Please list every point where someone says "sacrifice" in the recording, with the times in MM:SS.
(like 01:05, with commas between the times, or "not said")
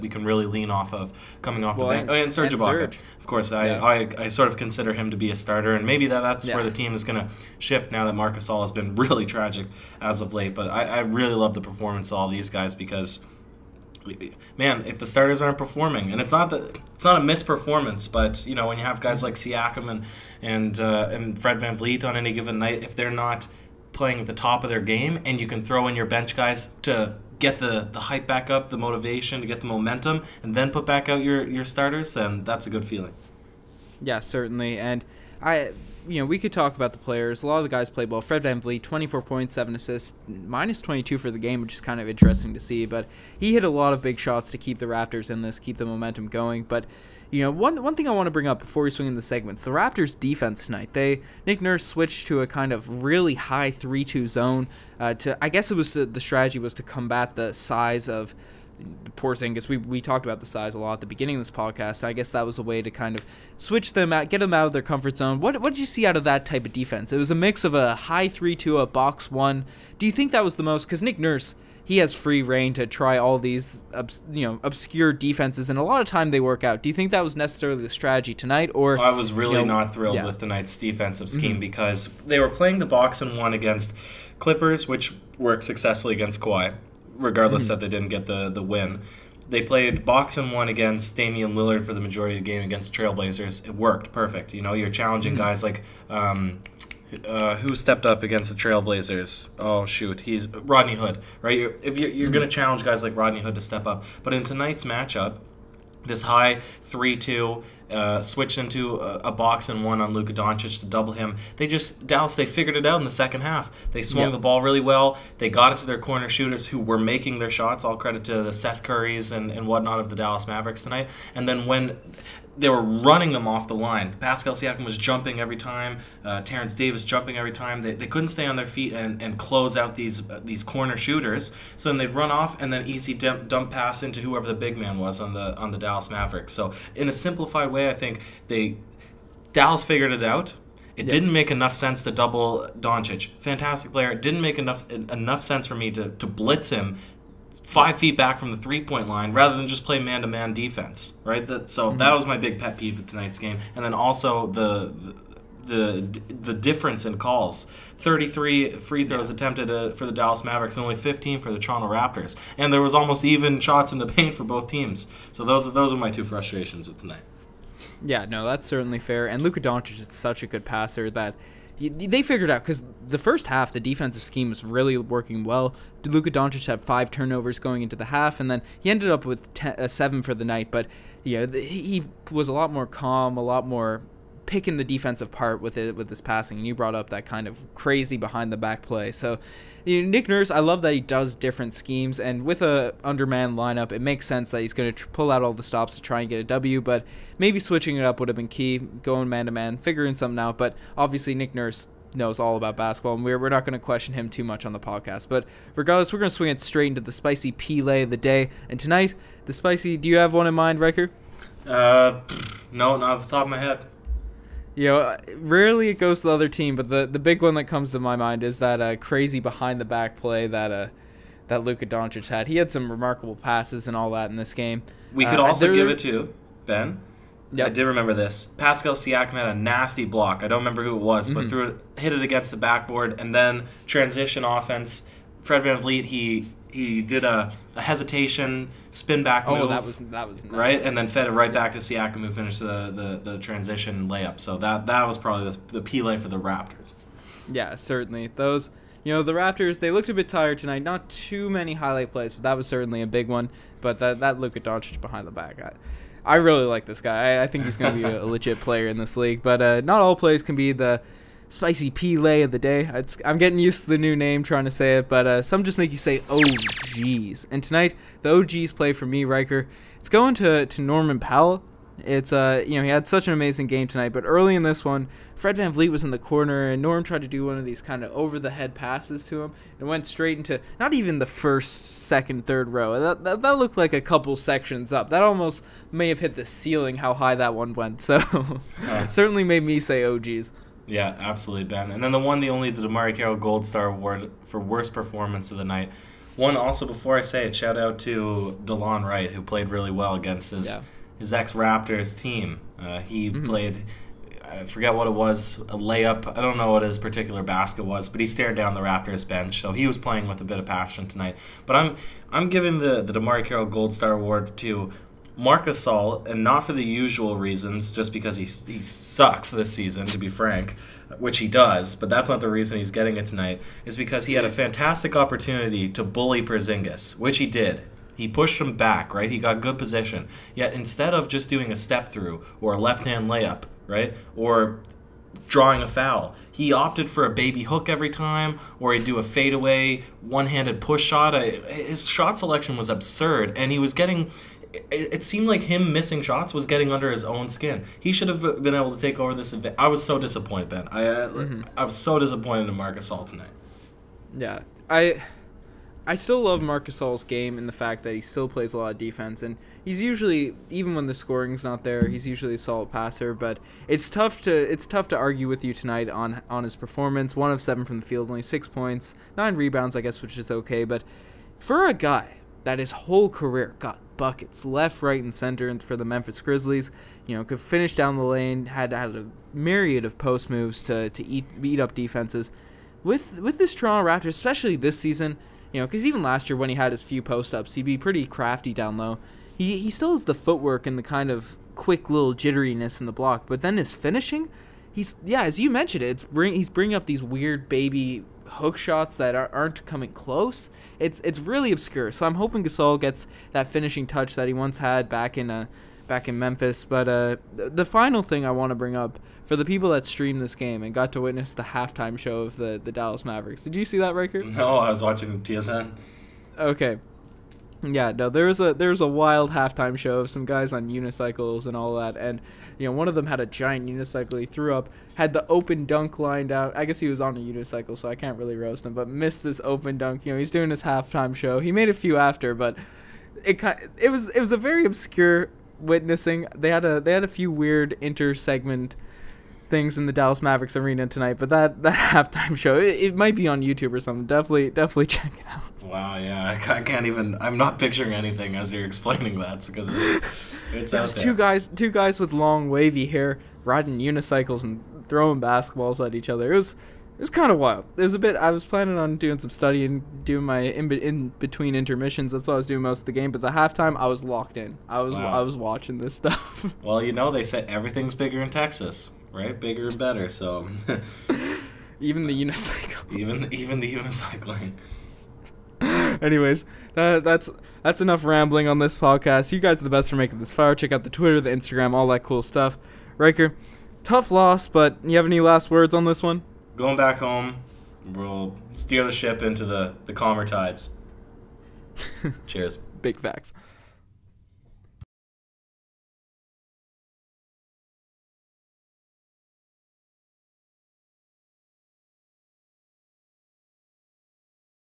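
not said.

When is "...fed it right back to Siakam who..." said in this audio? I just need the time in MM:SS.
04:01.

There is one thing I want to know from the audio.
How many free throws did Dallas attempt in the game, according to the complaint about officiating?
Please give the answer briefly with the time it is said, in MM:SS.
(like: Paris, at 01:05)
33, at 02:37.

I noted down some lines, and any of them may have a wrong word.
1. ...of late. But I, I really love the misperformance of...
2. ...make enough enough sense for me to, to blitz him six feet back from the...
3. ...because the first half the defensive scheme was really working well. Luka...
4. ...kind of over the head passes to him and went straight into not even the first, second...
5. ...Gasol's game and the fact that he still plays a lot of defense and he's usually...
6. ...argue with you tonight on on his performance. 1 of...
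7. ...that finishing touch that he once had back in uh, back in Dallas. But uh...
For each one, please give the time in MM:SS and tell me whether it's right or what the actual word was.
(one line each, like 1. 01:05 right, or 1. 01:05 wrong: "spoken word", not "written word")
1. 00:10 wrong: "performance", not "misperformance"
2. 02:24 wrong: "five", not "six"
3. 02:52 right
4. 04:37 right
5. 05:56 right
6. 06:05 right
7. 06:43 wrong: "Memphis", not "Dallas".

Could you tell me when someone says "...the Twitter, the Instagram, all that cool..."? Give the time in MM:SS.
08:01.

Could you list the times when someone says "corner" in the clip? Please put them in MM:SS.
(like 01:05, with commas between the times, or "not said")
01:55, 02:10, 04:36.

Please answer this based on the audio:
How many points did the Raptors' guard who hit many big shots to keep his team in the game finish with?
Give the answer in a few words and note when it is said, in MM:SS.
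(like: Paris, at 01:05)
24, at 00:38.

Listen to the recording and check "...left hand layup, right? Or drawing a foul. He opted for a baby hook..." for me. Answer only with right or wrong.
right.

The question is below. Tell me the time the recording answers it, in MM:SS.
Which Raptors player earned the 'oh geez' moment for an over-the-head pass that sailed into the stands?
04:30.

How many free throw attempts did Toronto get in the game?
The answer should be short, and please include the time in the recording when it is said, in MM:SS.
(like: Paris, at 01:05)
15, at 02:40.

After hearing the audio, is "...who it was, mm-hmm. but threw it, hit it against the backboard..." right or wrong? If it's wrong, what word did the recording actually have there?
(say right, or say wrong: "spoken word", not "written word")
right.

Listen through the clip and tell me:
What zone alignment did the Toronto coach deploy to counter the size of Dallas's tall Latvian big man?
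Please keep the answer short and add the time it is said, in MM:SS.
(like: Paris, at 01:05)
high 3 2 zone, at 00:53.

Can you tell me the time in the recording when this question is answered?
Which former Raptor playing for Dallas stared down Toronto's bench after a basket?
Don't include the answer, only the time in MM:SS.
04:58.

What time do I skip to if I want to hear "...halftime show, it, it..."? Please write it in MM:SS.
07:22.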